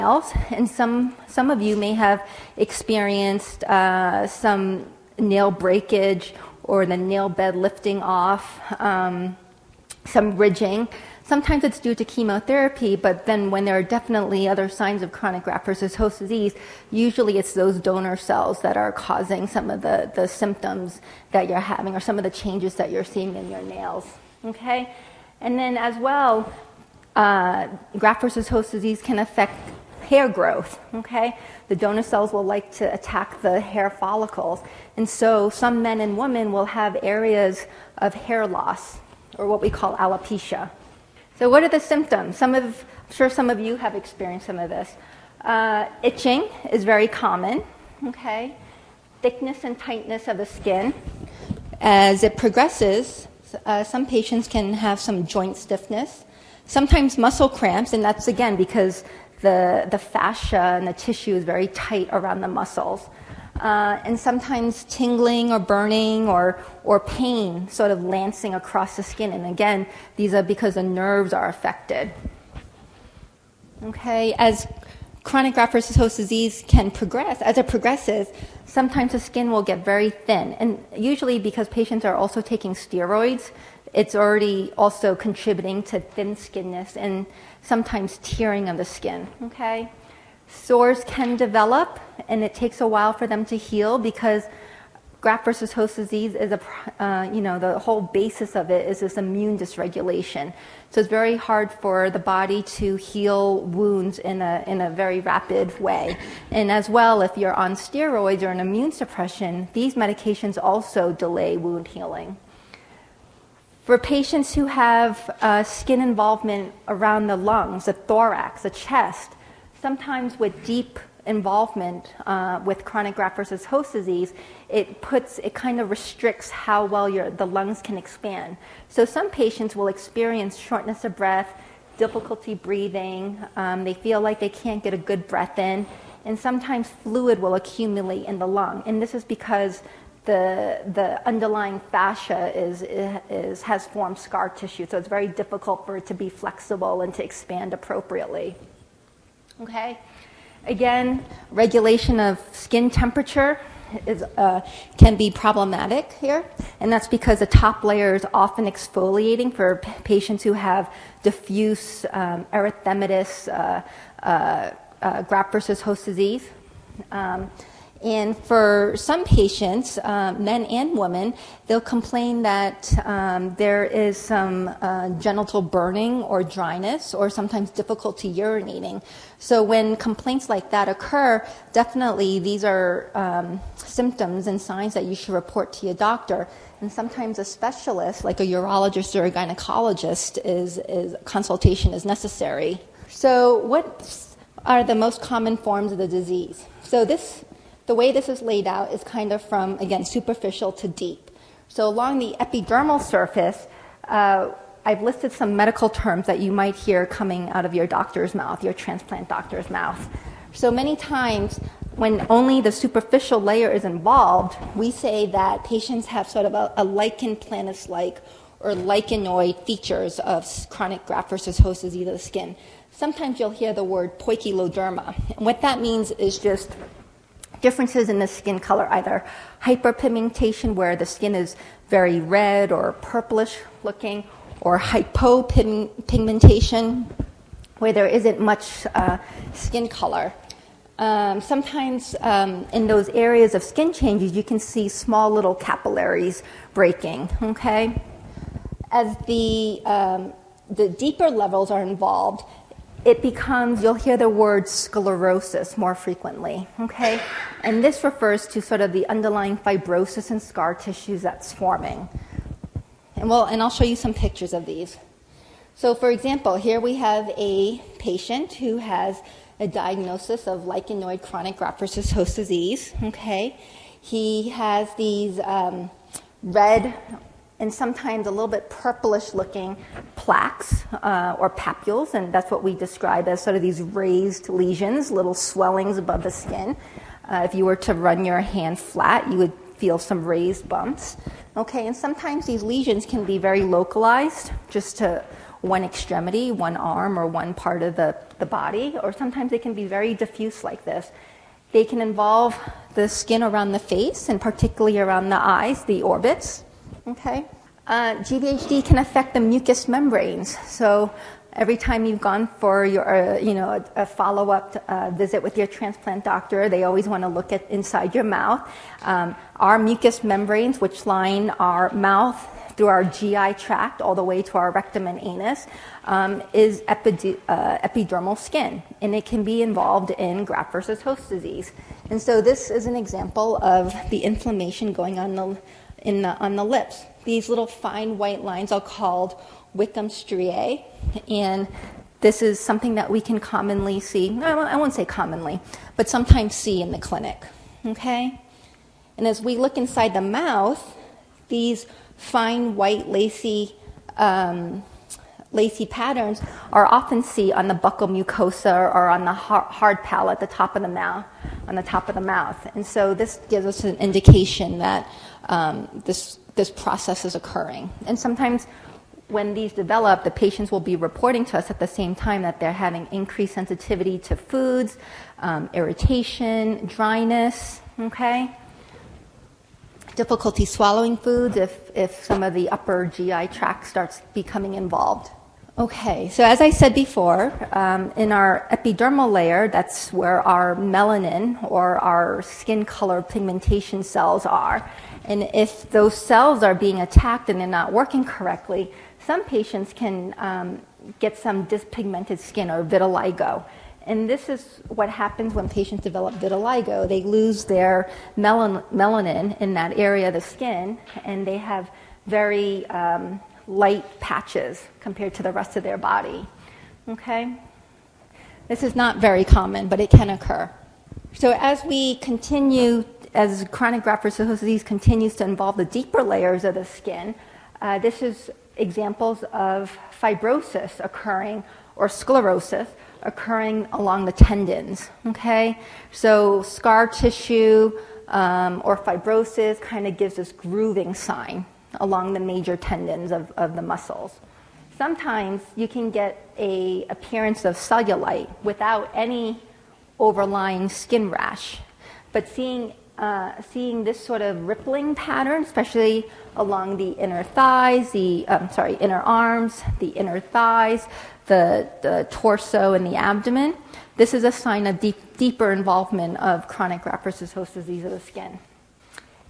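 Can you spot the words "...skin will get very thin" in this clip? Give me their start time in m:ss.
1:19.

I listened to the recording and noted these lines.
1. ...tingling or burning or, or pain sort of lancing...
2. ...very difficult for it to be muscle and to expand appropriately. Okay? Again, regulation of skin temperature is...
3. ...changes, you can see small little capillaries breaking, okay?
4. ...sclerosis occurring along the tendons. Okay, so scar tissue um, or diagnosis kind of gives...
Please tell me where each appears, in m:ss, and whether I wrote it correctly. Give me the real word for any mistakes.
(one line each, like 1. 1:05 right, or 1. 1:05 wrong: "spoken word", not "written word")
1. 1:04 right
2. 2:25 wrong: "flexible", not "muscle"
3. 4:03 right
4. 7:12 wrong: "fibrosis", not "diagnosis".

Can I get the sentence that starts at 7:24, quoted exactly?
Sometimes you can get a appearance of cellulite without any overlying skin rash.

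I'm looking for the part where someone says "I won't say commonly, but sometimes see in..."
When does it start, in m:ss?
5:44.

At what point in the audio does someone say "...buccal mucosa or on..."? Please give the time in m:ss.
5:57.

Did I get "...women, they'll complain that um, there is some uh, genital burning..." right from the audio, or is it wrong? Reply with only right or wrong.
right.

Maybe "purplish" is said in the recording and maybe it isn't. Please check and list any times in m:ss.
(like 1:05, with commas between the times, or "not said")
3:53, 4:38.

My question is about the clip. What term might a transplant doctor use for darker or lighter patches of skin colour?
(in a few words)
poikiloderma.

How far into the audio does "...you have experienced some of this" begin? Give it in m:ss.
0:43.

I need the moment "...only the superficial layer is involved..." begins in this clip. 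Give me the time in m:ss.
3:32.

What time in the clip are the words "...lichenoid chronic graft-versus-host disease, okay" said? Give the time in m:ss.
4:30.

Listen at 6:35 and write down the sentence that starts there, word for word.
And if those cells are being attacked and they're not working correctly, some patients can um, get some dyspigmented skin or vitiligo.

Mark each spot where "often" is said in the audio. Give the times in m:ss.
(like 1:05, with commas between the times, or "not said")
2:38, 5:56.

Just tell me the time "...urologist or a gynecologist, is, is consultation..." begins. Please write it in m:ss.
3:08.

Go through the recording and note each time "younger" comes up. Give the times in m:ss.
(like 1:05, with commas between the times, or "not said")
not said.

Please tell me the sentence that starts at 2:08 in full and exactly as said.
So some patients will experience shortness of breath, difficulty breathing.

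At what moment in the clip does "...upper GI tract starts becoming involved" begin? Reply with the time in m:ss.
6:22.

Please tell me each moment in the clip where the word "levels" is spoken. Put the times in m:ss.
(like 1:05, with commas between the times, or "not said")
4:11.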